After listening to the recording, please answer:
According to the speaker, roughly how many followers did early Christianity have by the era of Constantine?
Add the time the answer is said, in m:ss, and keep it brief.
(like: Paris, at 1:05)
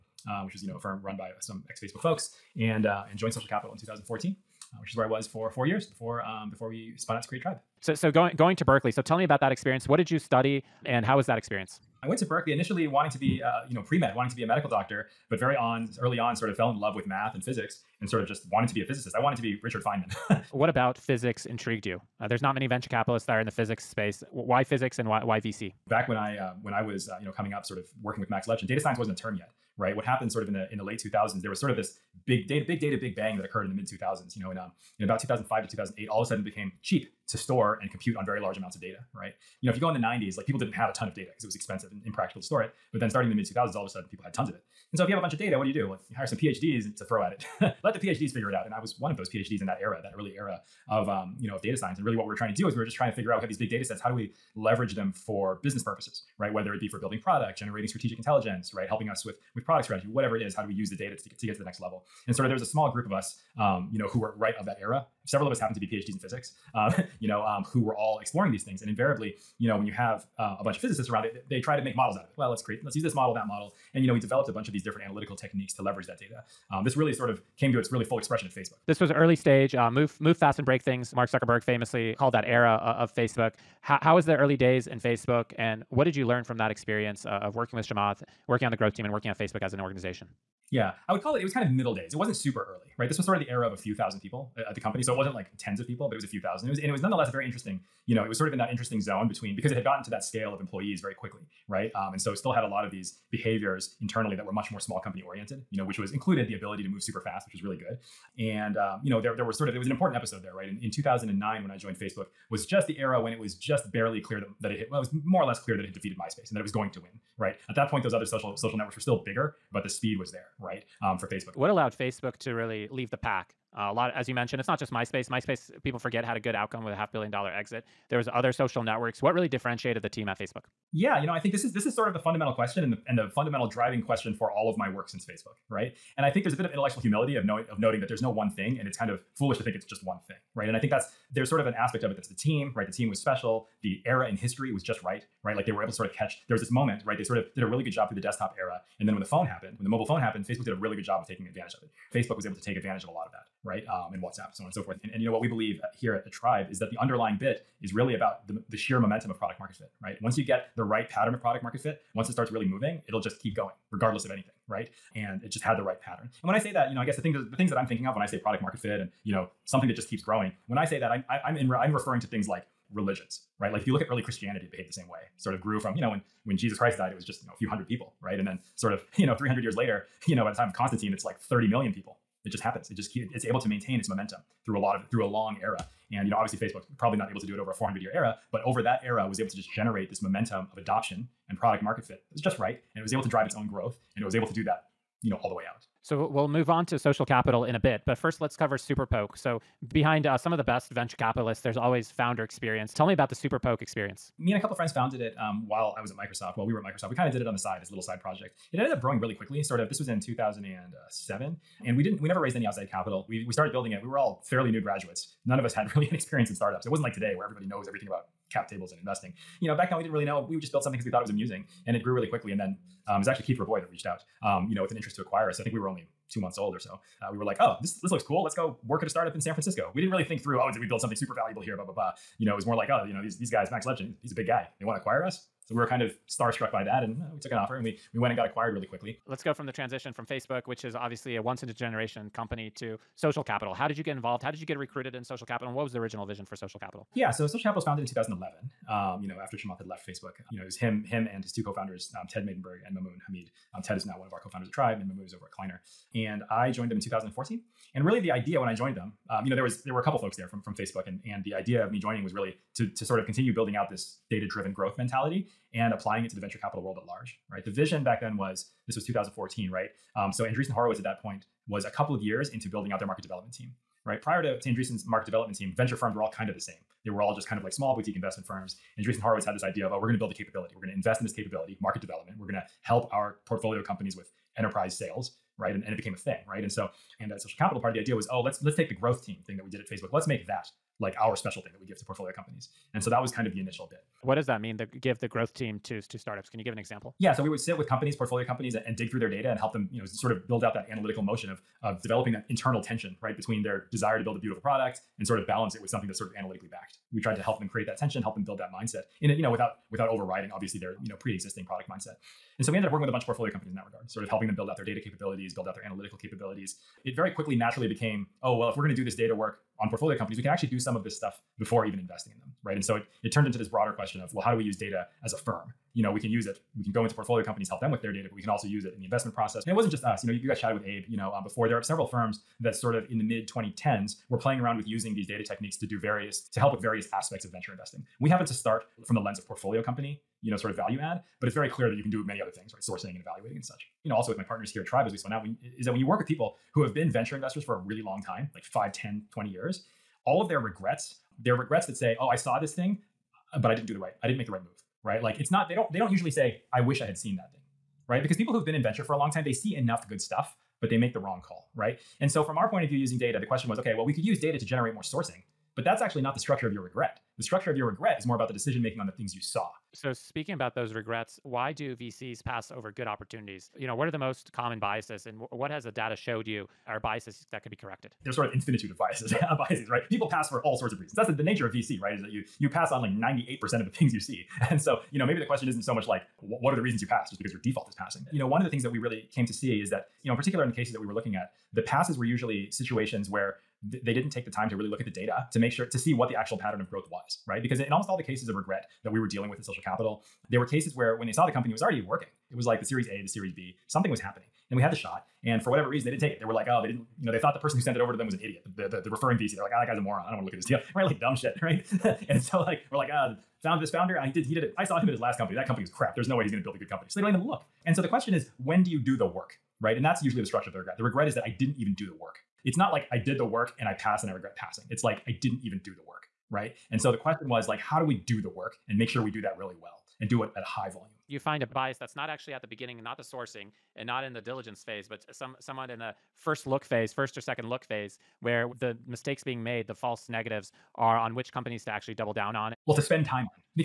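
30 million, at 3:01.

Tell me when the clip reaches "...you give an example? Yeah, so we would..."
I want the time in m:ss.
4:56.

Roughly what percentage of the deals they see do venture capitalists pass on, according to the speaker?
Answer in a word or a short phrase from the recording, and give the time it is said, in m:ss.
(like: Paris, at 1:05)
98%, at 6:23.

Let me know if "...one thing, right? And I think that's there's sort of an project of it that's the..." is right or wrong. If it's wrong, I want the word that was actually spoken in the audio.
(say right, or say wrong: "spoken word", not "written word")
wrong: "aspect", not "project".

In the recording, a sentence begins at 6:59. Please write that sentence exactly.
And that's usually the structure of the regret.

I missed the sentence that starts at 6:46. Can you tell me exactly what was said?
They were like, oh, they didn't you know, they thought the person who sent it over to them was an idiot.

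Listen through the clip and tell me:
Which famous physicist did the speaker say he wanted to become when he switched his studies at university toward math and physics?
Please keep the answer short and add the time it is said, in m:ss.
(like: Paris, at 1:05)
Richard Feynman, at 0:19.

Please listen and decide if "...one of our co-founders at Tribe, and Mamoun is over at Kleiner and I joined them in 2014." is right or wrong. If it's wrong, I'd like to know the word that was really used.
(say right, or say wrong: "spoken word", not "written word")
right.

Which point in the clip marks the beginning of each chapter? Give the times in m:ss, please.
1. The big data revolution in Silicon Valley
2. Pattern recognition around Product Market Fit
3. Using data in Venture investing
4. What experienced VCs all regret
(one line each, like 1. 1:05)
1. 0:13
2. 2:30
3. 5:17
4. 6:40.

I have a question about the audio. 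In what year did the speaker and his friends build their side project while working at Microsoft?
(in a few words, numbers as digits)
2007.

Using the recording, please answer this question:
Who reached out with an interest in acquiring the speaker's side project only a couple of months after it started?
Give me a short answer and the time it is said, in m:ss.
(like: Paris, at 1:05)
Keith Rabois, at 3:43.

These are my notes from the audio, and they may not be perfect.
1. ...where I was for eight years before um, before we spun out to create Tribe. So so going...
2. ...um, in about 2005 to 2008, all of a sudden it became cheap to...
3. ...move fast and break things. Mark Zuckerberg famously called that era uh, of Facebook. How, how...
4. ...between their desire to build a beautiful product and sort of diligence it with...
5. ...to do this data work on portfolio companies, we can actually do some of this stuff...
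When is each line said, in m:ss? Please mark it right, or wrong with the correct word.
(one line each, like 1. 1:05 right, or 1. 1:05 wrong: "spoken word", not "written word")
1. 0:04 wrong: "four", not "eight"
2. 0:34 right
3. 1:20 right
4. 5:03 wrong: "balance", not "diligence"
5. 5:18 right.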